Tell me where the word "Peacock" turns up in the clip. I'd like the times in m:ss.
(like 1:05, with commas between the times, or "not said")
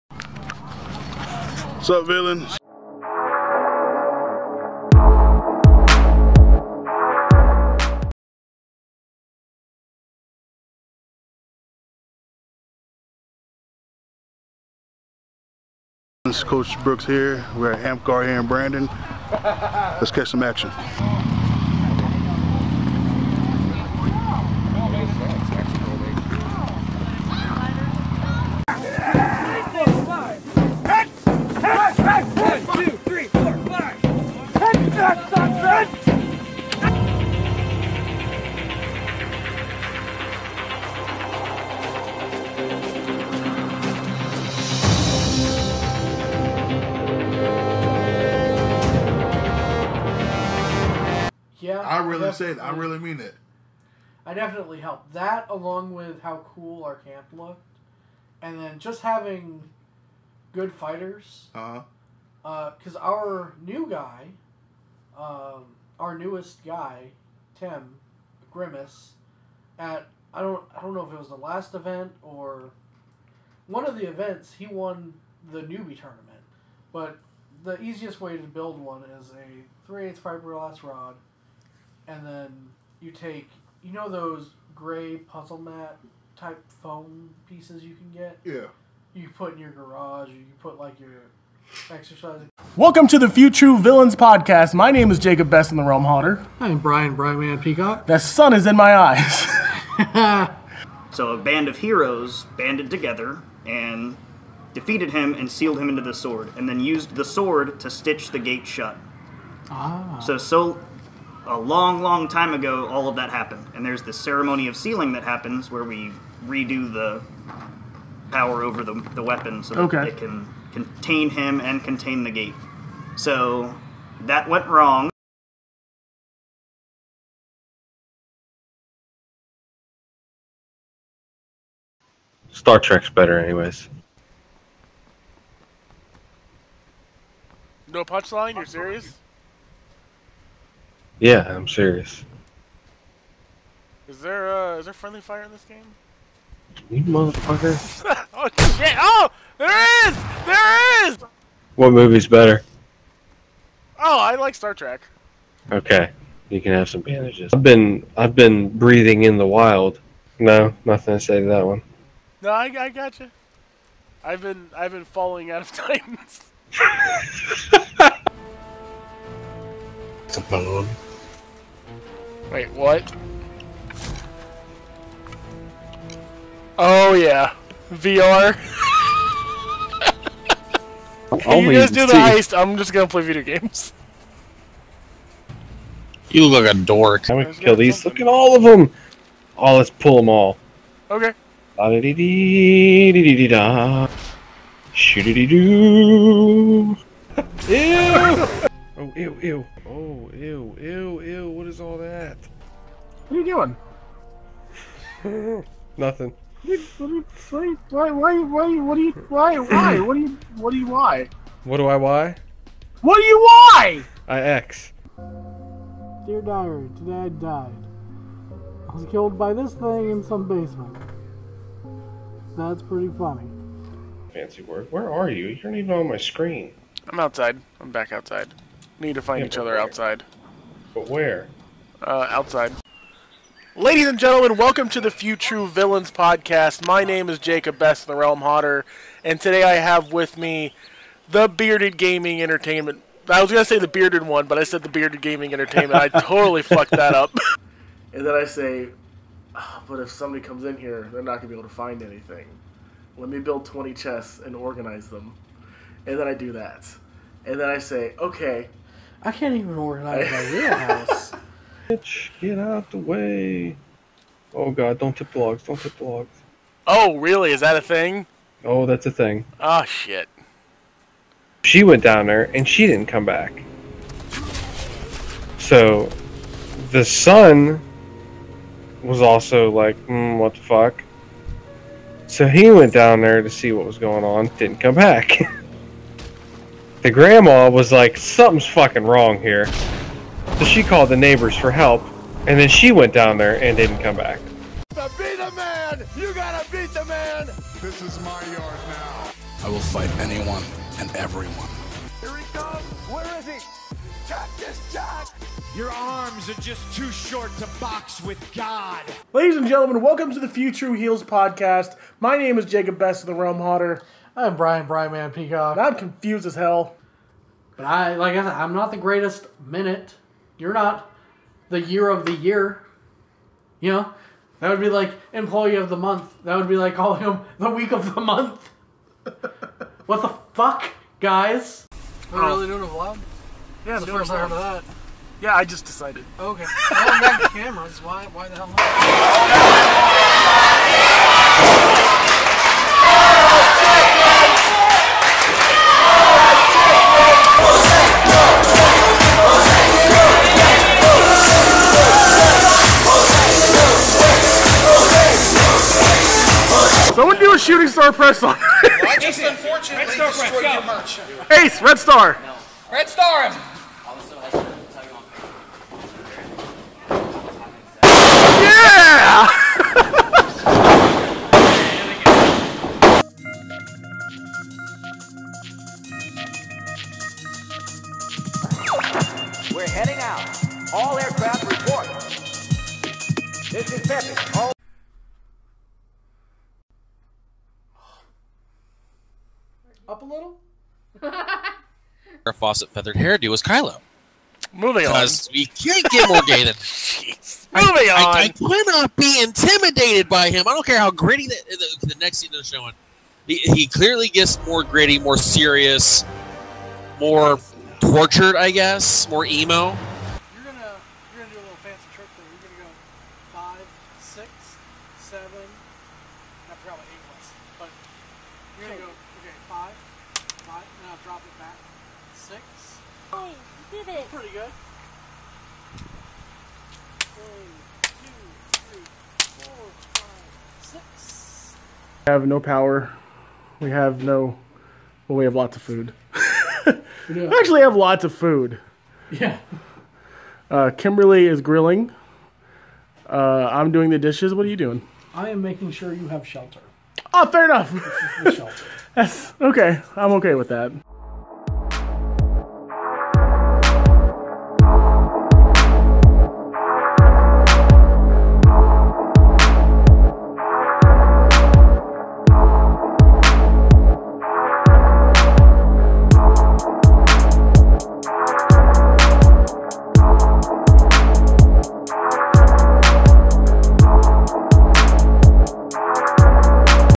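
1:37, 5:15.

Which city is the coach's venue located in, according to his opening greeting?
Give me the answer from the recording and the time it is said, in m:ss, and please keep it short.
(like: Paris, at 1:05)
Brandon, at 0:18.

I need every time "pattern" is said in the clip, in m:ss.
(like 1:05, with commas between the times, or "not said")
not said.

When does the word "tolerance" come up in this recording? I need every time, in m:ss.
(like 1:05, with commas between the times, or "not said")
not said.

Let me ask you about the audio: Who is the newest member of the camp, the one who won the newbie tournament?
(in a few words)
Tim Grimace.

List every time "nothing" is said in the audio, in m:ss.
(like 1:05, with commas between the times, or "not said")
2:40, 3:25.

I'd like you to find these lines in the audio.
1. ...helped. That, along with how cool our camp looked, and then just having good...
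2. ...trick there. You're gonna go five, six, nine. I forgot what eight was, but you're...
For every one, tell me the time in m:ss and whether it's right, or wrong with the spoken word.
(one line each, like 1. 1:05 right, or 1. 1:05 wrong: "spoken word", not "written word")
1. 0:54 right
2. 6:52 wrong: "seven", not "nine".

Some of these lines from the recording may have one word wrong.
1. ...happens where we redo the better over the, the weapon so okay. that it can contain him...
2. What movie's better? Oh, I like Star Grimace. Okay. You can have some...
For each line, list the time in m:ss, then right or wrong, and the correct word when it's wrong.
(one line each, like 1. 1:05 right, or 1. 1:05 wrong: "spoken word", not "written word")
1. 1:55 wrong: "power", not "better"
2. 2:31 wrong: "Trek", not "Grimace".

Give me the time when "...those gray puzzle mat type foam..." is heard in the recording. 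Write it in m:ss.
1:24.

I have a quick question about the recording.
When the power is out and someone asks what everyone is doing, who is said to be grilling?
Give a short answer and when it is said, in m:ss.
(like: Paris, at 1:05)
Kimberly, at 7:20.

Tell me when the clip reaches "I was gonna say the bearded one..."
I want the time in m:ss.
4:03.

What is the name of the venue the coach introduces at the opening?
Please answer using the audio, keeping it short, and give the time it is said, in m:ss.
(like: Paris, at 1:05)
Amcar, at 0:17.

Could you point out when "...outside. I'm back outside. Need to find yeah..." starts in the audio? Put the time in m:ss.
3:47.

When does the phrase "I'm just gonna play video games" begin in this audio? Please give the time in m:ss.
3:02.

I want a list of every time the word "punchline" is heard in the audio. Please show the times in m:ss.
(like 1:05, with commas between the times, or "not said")
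2:18.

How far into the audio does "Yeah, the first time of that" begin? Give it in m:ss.
5:33.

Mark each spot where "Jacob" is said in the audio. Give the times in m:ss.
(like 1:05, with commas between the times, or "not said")
1:35, 3:57, 5:12.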